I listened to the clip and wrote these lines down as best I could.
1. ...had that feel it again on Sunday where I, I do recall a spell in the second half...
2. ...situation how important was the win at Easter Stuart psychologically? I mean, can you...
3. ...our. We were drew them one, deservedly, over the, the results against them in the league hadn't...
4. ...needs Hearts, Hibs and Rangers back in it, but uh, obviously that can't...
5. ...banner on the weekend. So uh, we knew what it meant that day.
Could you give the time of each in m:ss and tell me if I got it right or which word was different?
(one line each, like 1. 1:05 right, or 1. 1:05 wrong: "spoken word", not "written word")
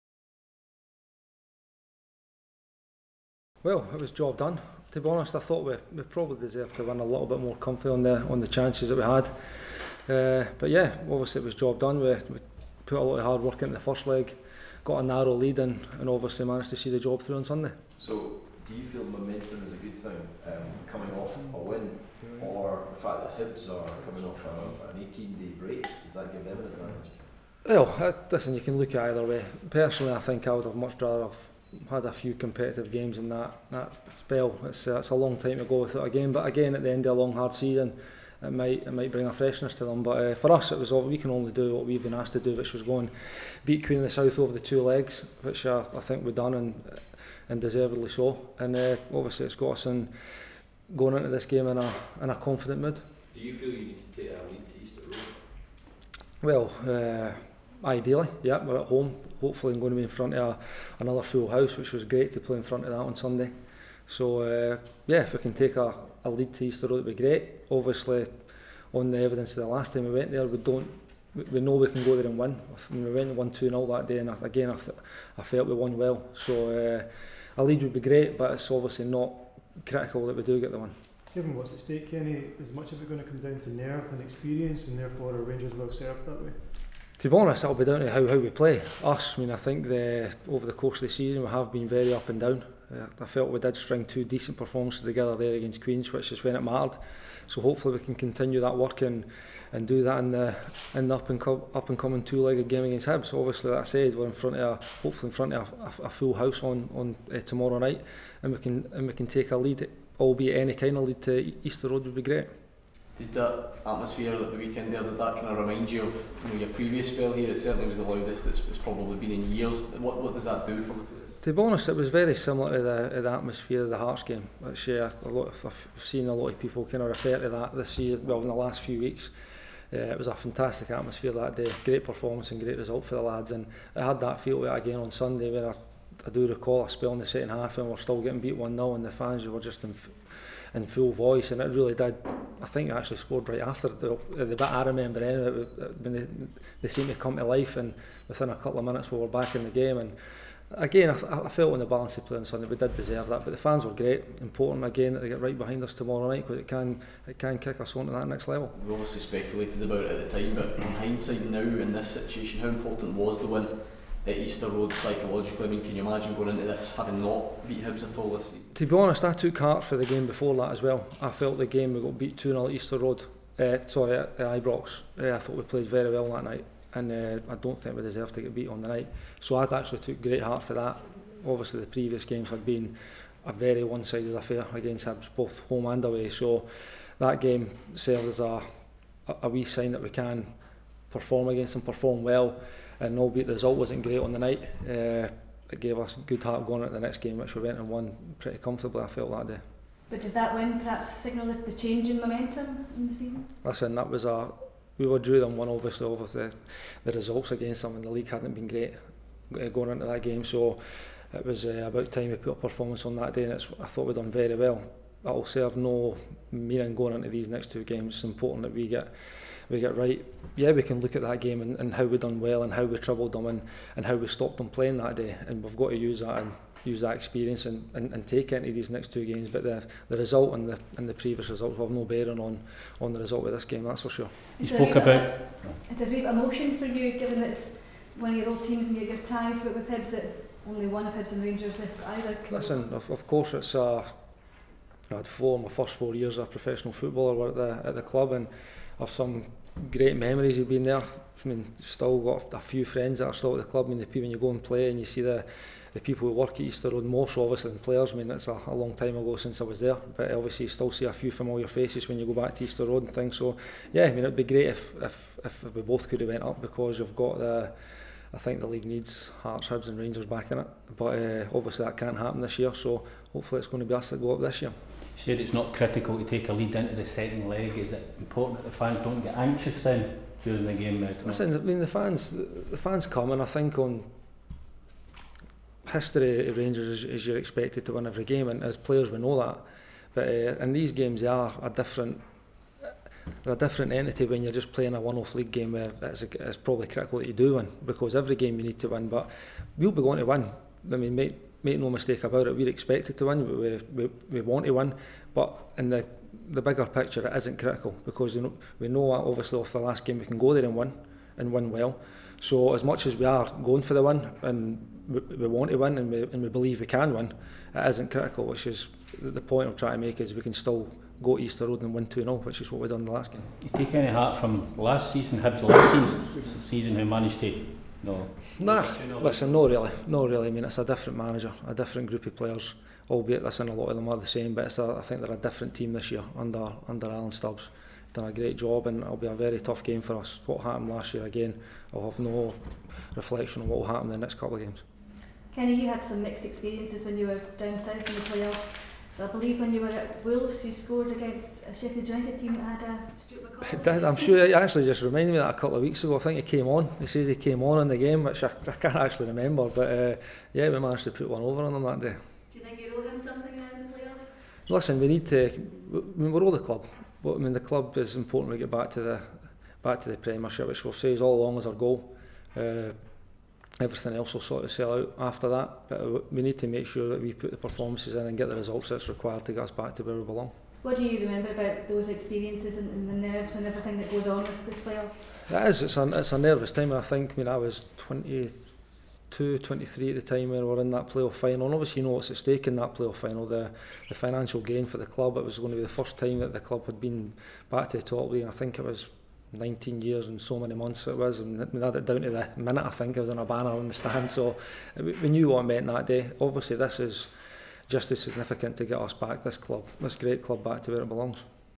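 1. 2:14 right
2. 2:42 wrong: "Road", not "Stuart"
3. 3:24 wrong: "obviously", not "deservedly"
4. 4:28 right
5. 6:43 wrong: "stand", not "weekend".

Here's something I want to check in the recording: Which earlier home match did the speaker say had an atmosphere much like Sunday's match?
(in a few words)
Hearts game.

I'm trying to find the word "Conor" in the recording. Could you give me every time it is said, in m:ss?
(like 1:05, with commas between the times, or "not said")
not said.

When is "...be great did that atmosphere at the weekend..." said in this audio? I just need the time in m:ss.
1:52.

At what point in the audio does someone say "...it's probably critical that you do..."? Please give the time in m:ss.
4:56.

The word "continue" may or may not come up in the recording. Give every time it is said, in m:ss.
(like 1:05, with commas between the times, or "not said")
1:38.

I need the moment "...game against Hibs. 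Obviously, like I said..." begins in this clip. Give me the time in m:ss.
1:42.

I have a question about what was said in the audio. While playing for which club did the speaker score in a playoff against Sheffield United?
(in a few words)
Wolves.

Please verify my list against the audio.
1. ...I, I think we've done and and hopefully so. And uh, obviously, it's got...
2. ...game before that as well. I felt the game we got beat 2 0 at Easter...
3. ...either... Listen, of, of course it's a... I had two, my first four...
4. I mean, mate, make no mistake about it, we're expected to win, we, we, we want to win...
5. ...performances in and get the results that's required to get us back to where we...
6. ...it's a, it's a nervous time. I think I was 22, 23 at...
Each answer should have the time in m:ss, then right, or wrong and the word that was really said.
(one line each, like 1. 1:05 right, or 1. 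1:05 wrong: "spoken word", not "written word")
1. 0:45 wrong: "deservedly", not "hopefully"
2. 2:50 right
3. 4:02 wrong: "four", not "two"
4. 5:00 right
5. 6:17 right
6. 6:25 right.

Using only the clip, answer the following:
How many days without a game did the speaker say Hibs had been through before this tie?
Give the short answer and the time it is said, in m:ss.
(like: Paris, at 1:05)
18, at 0:25.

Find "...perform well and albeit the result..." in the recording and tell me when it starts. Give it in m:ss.
3:11.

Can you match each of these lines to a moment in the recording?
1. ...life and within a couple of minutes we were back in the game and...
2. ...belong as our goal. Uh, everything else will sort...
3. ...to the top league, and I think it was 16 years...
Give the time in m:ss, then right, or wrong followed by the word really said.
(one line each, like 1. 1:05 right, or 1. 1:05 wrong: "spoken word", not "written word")
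1. 2:27 right
2. 6:11 wrong: "along", not "belong"
3. 6:37 wrong: "19", not "16".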